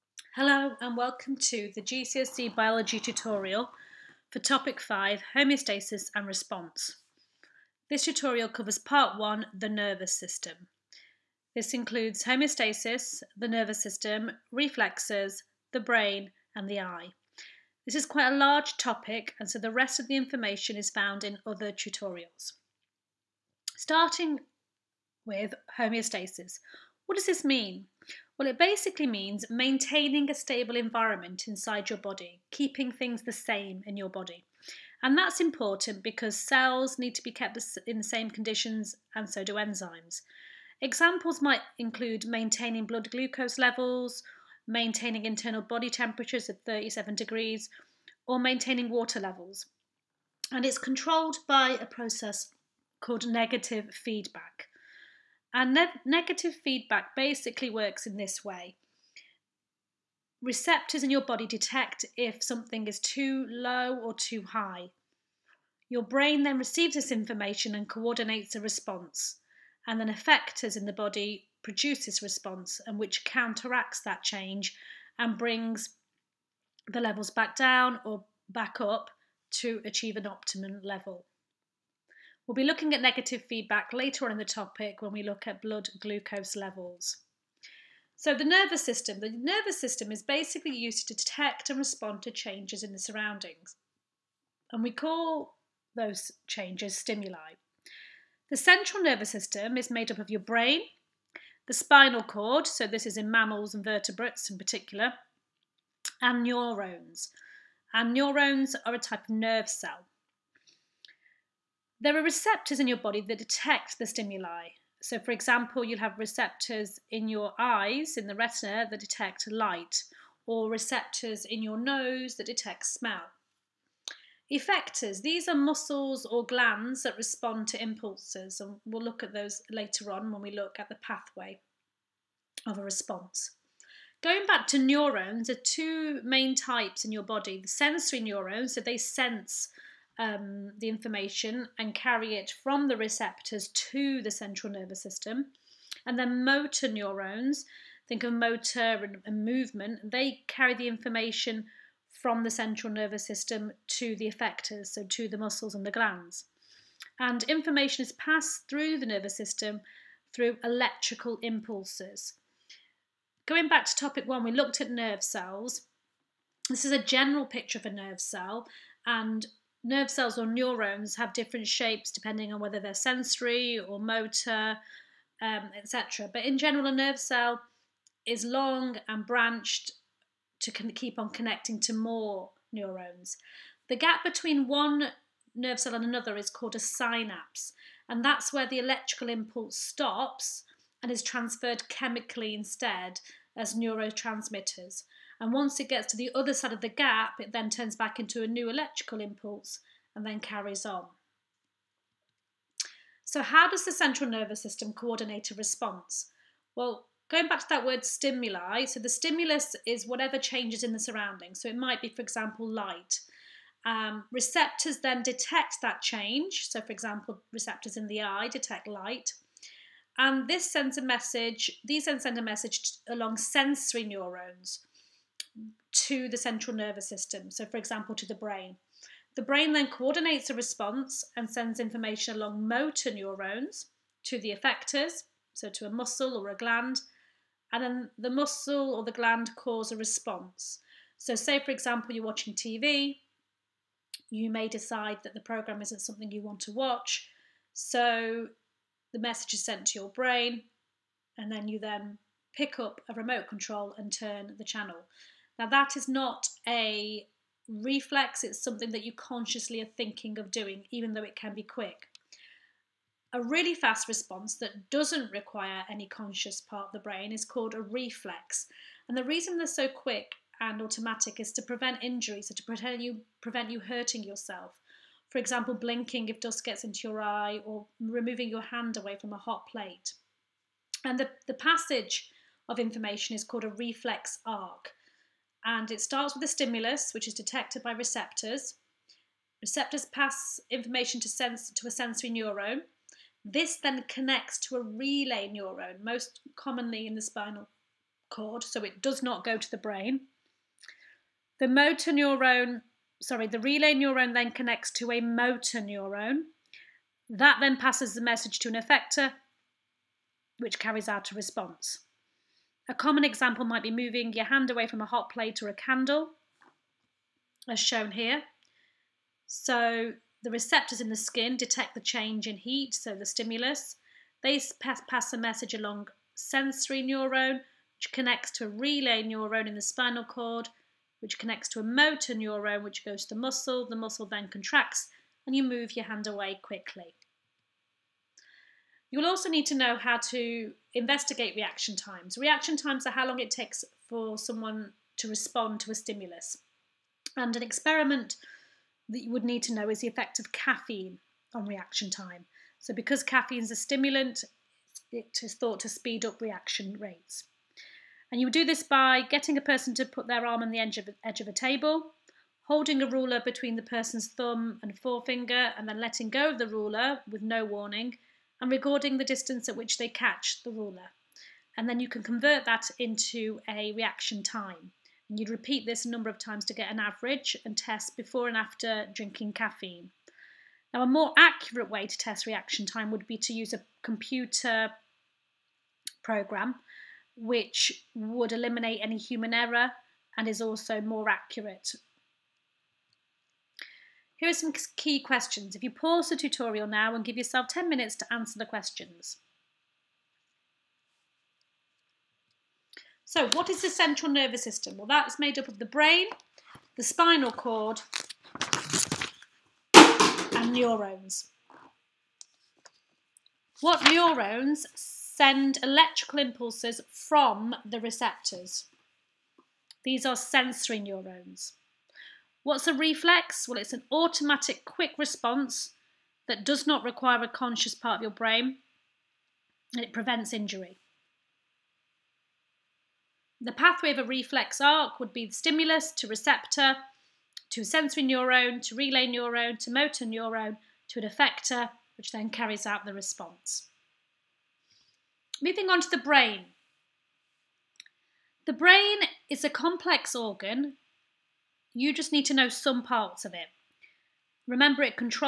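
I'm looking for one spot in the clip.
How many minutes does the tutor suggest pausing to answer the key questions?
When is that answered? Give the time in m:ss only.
6:37.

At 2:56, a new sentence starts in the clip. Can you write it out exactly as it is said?
But in general, a nerve cell is long and branched to keep on connecting to more neurons.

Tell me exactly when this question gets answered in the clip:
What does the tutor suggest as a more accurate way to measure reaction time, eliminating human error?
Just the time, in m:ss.
6:24.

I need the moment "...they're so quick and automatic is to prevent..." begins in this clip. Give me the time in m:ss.
4:29.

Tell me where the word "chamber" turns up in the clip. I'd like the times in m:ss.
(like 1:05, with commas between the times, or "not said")
not said.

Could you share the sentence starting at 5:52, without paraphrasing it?
So because caffeine is a stimulant, it is thought to speed up reaction rates.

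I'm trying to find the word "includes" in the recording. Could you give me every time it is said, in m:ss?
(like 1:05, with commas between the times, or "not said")
0:11, 0:41.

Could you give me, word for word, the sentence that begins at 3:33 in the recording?
Um, receptors then detect that change.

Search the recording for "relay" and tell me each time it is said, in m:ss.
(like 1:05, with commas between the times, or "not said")
4:54, 5:03, 5:28, 7:18.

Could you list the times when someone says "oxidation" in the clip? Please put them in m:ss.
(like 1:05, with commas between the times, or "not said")
not said.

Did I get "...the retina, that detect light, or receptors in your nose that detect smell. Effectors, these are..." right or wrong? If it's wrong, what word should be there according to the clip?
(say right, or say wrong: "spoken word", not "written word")
right.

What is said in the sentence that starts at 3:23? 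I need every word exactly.
So how does the central nervous system coordinate a response?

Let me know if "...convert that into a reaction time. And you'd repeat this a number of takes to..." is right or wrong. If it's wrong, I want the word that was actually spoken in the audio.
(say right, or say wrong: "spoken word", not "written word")
wrong: "times", not "takes".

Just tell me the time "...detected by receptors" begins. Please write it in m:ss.
4:47.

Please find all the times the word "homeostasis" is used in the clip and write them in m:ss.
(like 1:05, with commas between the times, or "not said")
0:05, 0:12, 0:25.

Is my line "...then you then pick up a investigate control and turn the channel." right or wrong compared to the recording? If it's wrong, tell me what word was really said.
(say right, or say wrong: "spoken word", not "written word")
wrong: "remote", not "investigate".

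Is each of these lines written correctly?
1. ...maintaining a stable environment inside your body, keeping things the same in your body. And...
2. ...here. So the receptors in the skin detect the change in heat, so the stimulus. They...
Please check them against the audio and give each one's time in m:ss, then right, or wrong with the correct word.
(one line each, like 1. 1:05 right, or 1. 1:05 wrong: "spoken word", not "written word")
1. 0:29 right
2. 5:18 right.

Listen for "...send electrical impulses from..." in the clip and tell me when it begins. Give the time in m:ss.
6:54.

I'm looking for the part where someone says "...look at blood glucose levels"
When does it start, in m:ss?
1:25.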